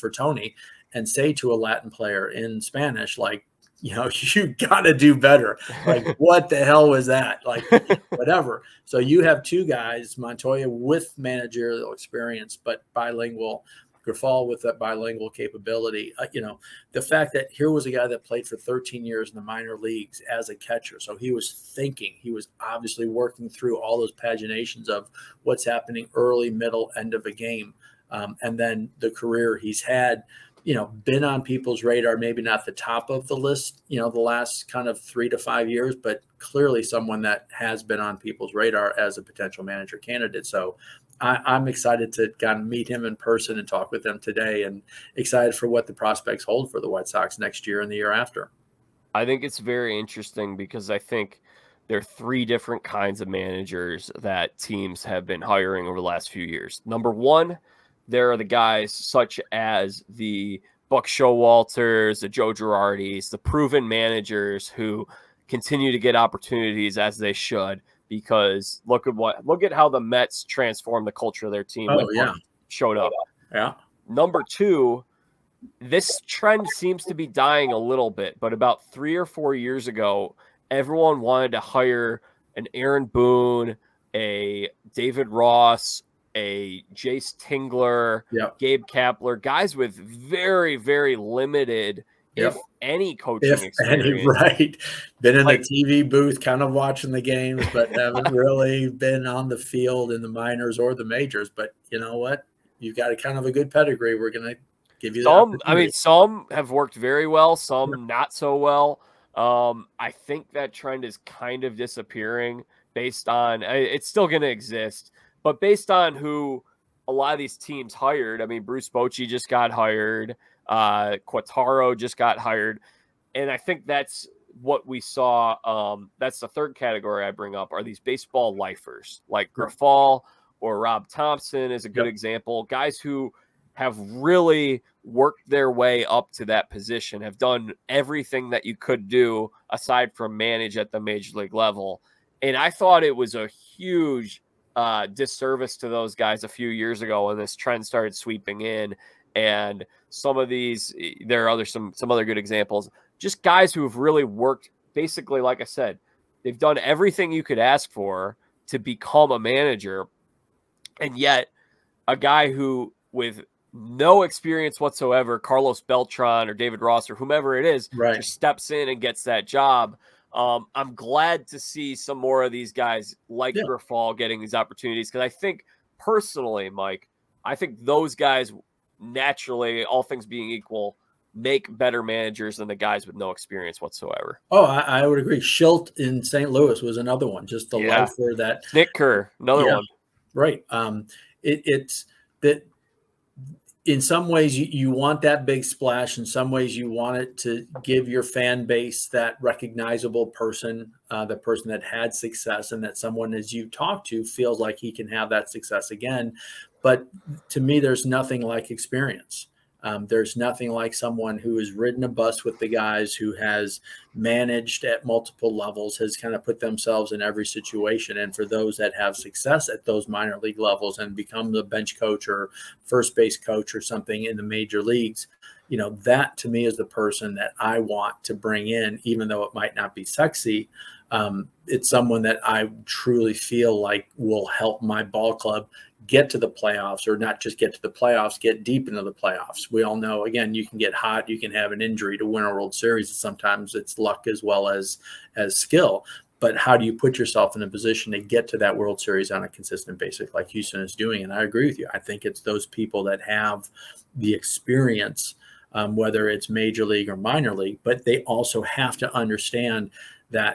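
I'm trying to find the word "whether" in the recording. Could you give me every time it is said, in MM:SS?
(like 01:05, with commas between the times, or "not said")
04:15.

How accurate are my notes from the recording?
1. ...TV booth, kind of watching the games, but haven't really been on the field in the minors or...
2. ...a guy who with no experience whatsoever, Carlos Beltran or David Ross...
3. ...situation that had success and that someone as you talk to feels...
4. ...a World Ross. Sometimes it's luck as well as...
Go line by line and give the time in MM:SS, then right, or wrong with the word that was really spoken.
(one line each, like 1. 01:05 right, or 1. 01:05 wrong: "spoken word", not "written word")
1. 01:35 right
2. 02:42 right
3. 03:21 wrong: "person", not "situation"
4. 04:02 wrong: "Series", not "Ross".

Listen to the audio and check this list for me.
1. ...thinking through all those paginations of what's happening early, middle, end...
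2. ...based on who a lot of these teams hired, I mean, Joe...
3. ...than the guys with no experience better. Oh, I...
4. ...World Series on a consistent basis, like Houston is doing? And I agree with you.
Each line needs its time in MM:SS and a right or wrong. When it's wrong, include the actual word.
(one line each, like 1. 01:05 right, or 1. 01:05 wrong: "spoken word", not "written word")
1. 00:23 wrong: "working", not "thinking"
2. 01:55 wrong: "Bruce", not "Joe"
3. 03:02 wrong: "whatsoever", not "better"
4. 04:08 right.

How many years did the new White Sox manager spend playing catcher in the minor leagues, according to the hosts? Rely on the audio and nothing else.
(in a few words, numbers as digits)
13.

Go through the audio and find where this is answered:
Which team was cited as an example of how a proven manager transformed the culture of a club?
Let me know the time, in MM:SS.
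01:10.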